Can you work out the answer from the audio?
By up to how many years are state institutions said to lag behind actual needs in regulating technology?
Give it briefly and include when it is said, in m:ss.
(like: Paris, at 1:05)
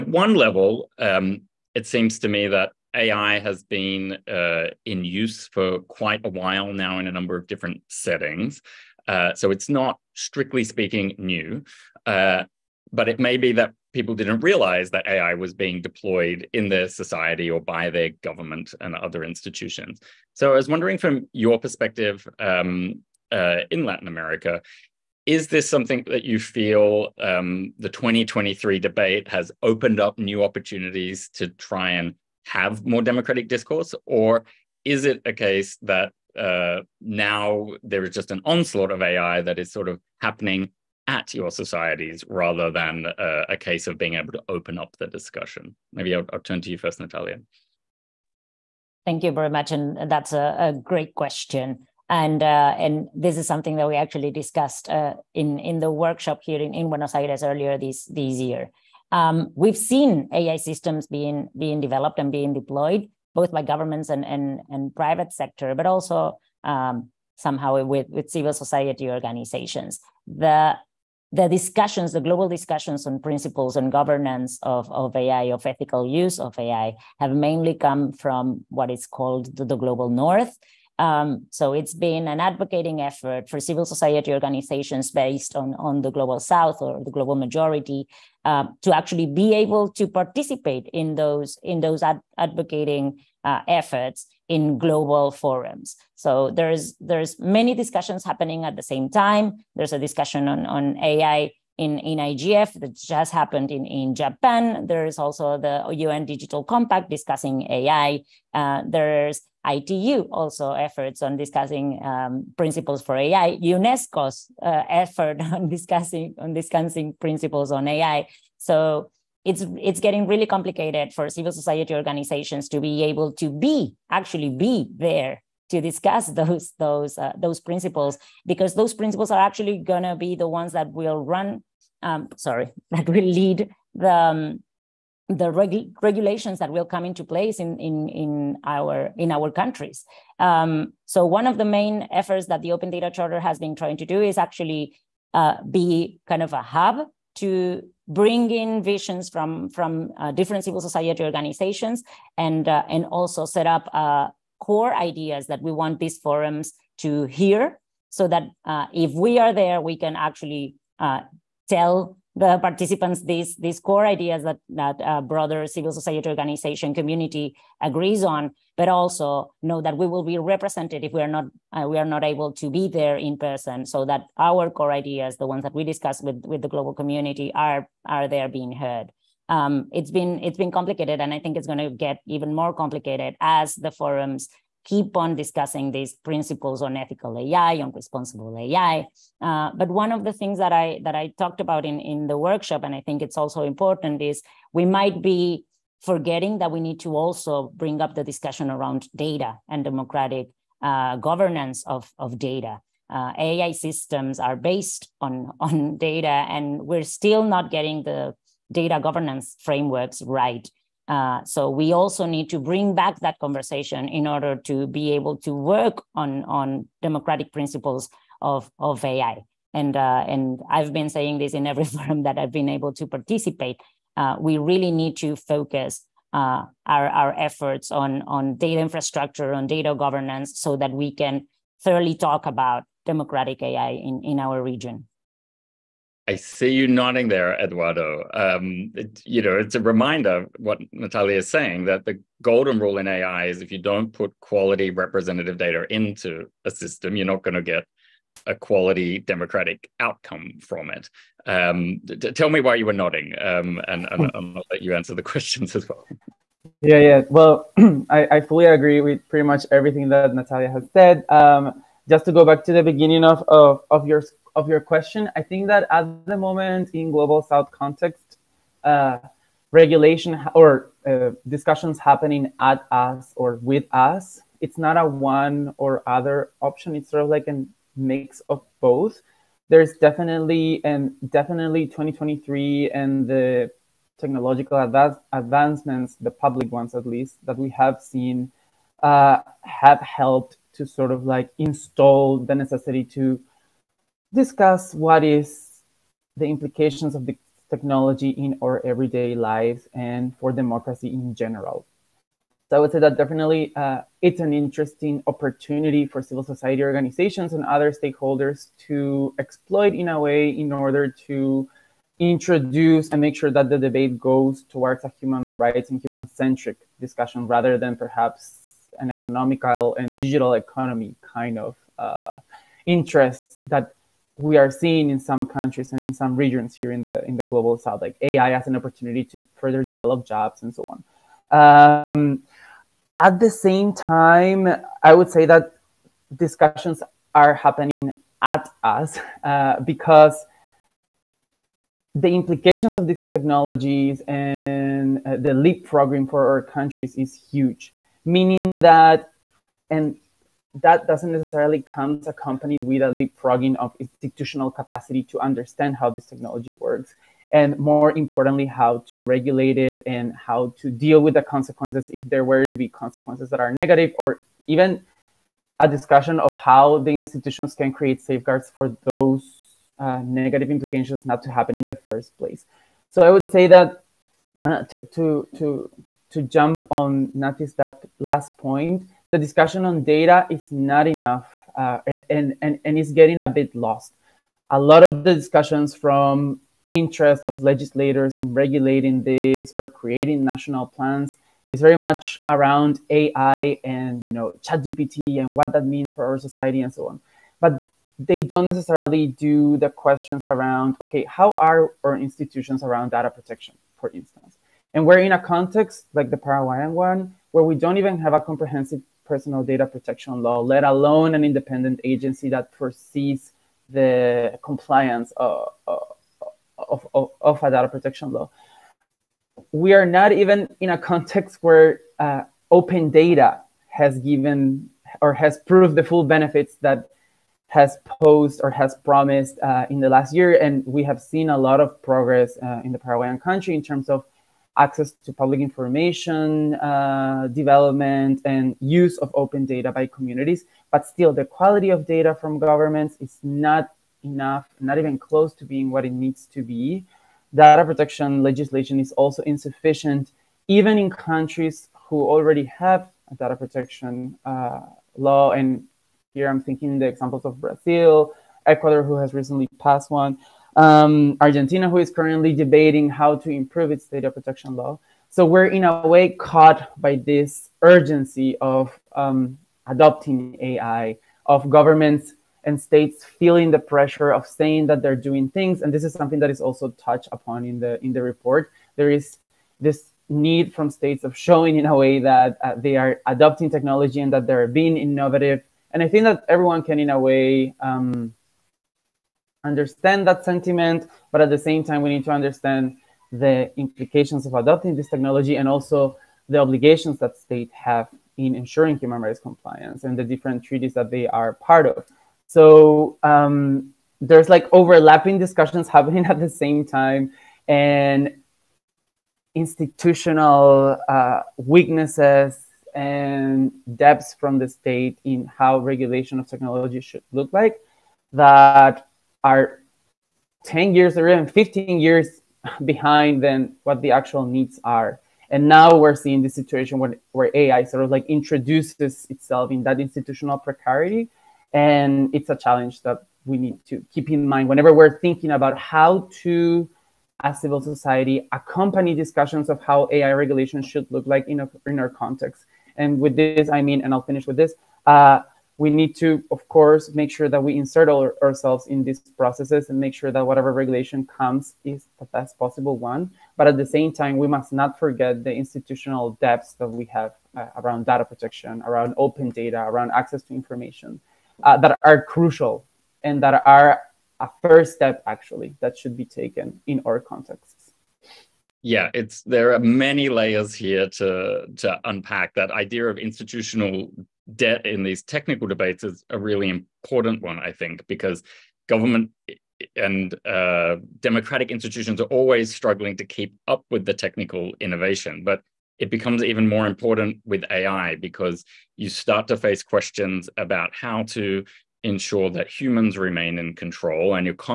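15 years, at 8:41.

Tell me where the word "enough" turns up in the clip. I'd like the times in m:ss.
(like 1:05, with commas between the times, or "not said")
6:21, 7:24.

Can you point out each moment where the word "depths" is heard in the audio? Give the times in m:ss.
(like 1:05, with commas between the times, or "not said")
8:33, 9:16.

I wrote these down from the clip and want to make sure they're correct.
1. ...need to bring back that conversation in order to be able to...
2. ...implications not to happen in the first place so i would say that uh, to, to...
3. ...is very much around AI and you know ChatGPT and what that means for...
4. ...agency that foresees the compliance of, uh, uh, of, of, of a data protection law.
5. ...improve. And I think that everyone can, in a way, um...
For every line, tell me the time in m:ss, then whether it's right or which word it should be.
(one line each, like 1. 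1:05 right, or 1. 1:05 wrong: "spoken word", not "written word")
1. 3:32 right
2. 6:10 right
3. 6:31 right
4. 6:52 right
5. 8:04 wrong: "innovative", not "improve".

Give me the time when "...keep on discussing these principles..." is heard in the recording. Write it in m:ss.
3:04.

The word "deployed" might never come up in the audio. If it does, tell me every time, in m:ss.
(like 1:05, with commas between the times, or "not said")
0:15, 1:02.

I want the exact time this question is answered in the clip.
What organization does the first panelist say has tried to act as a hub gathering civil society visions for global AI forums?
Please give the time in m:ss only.
2:22.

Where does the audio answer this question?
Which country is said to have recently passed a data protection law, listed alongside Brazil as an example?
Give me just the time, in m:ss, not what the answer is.
7:38.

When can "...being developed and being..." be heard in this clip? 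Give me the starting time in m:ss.
1:01.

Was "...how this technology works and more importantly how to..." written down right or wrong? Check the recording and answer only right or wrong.
right.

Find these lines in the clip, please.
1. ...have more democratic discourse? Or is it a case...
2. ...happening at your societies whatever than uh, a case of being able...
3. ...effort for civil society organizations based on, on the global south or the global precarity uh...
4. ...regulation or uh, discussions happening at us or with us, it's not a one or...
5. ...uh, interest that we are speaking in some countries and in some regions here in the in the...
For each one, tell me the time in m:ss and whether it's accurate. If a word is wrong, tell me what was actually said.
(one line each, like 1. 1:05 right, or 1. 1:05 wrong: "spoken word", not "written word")
1. 0:32 right
2. 0:40 wrong: "rather", not "whatever"
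3. 1:23 wrong: "majority", not "precarity"
4. 4:29 right
5. 5:21 wrong: "seeing", not "speaking".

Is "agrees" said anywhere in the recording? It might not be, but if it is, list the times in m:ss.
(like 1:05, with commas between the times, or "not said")
2:47, 4:18.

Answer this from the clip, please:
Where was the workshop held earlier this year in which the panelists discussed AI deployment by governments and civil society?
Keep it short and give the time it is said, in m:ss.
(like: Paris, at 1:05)
Buenos Aires, at 0:56.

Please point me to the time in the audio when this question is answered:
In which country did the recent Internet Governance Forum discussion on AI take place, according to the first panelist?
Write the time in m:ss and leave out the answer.
1:44.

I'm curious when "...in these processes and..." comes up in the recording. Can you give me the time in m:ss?
9:08.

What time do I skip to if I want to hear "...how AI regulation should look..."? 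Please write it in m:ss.
8:59.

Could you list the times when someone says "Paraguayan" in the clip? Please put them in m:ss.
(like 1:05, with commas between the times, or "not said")
6:46, 7:13.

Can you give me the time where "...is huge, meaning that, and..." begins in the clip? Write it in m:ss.
5:47.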